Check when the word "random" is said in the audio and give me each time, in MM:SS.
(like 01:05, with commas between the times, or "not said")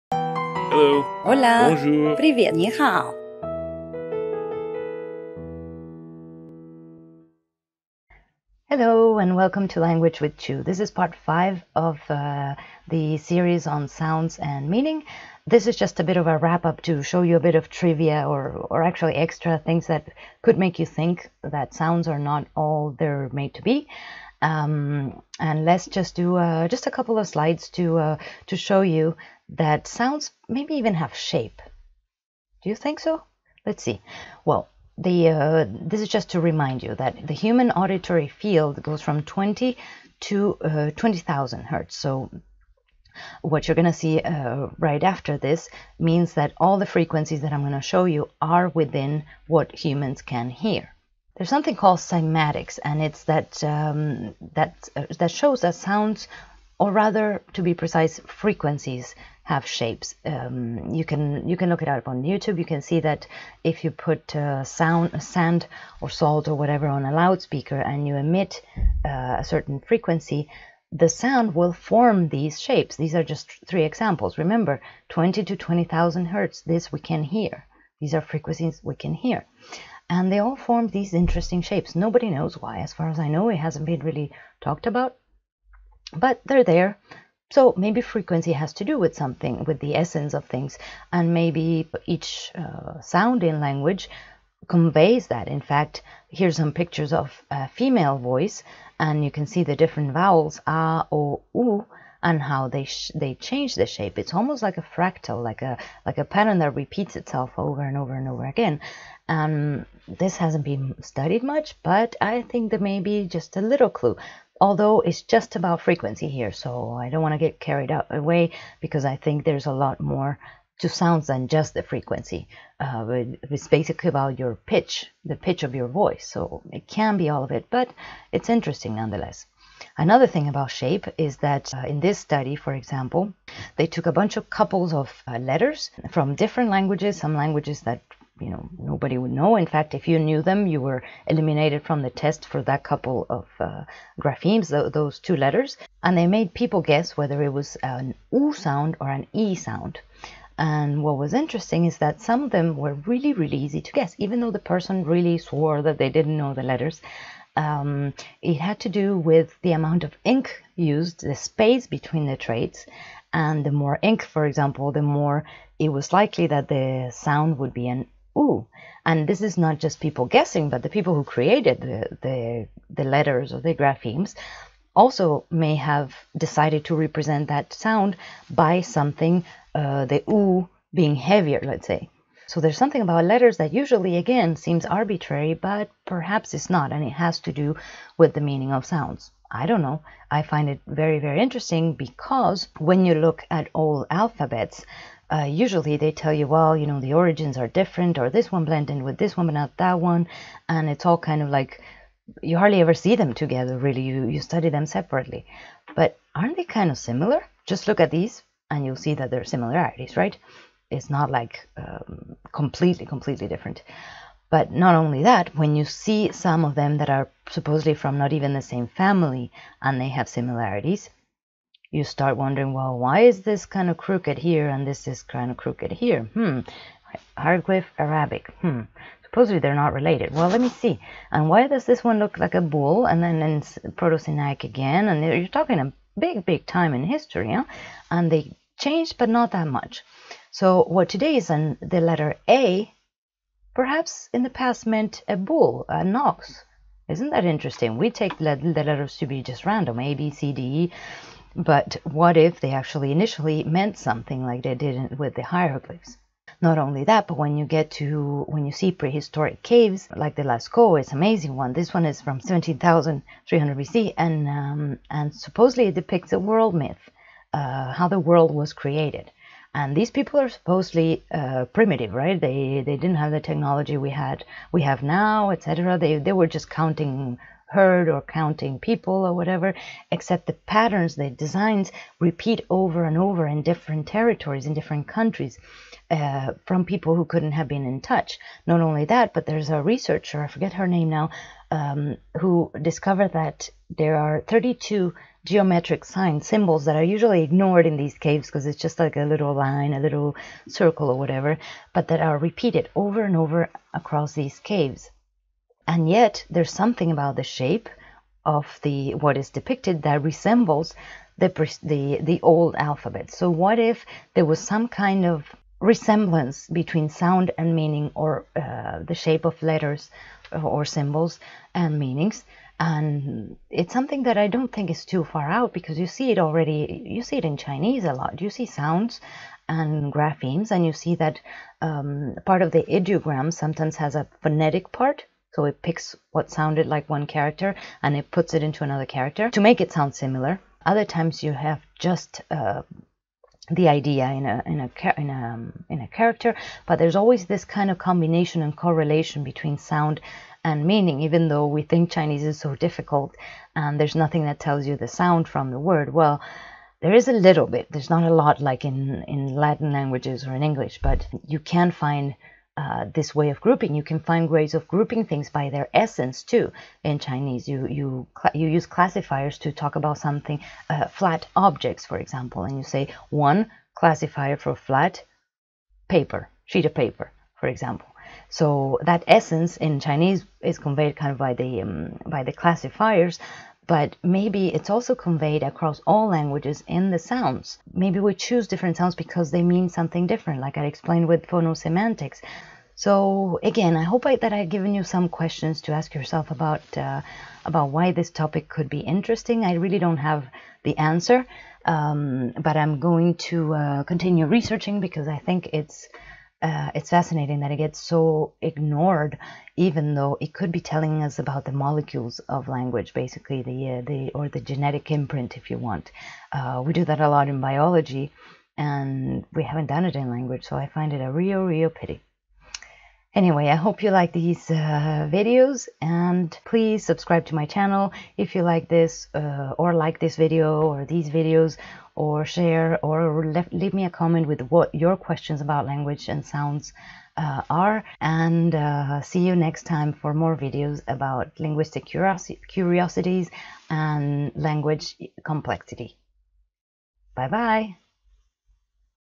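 04:09.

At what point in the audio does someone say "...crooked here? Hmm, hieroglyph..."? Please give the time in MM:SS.
03:45.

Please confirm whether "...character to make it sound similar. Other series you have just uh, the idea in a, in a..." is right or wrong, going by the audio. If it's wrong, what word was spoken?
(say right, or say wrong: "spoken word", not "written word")
wrong: "times", not "series".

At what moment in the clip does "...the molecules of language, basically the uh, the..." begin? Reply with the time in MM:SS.
06:51.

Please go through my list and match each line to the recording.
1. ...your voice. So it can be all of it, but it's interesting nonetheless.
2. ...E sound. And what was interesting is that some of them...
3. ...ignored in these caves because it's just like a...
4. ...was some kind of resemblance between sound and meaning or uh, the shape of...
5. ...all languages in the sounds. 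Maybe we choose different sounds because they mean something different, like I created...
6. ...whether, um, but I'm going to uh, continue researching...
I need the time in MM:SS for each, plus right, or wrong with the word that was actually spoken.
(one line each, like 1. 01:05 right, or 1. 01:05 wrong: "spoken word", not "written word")
1. 02:05 right
2. 02:29 right
3. 04:57 right
4. 05:14 right
5. 06:26 wrong: "explained", not "created"
6. 06:40 wrong: "answer", not "whether".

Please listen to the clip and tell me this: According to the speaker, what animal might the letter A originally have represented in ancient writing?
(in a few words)
A bull (an ox).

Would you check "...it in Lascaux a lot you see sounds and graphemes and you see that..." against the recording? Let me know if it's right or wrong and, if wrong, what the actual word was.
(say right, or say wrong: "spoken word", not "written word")
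wrong: "Chinese", not "Lascaux".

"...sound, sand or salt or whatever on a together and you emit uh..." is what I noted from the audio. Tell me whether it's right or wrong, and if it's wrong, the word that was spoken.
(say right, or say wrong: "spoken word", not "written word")
wrong: "loudspeaker", not "together".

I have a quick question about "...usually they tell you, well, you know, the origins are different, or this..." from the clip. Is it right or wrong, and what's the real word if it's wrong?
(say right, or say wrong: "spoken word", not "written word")
right.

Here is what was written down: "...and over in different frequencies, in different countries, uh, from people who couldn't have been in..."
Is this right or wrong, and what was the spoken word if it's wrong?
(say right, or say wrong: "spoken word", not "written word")
wrong: "territories", not "frequencies".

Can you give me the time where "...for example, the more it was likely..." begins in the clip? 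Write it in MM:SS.
02:44.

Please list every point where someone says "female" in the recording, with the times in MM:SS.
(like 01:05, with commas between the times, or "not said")
01:37.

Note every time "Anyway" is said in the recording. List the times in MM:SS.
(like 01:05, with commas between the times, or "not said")
07:03.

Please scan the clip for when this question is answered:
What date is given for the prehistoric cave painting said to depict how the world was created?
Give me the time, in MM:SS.
04:22.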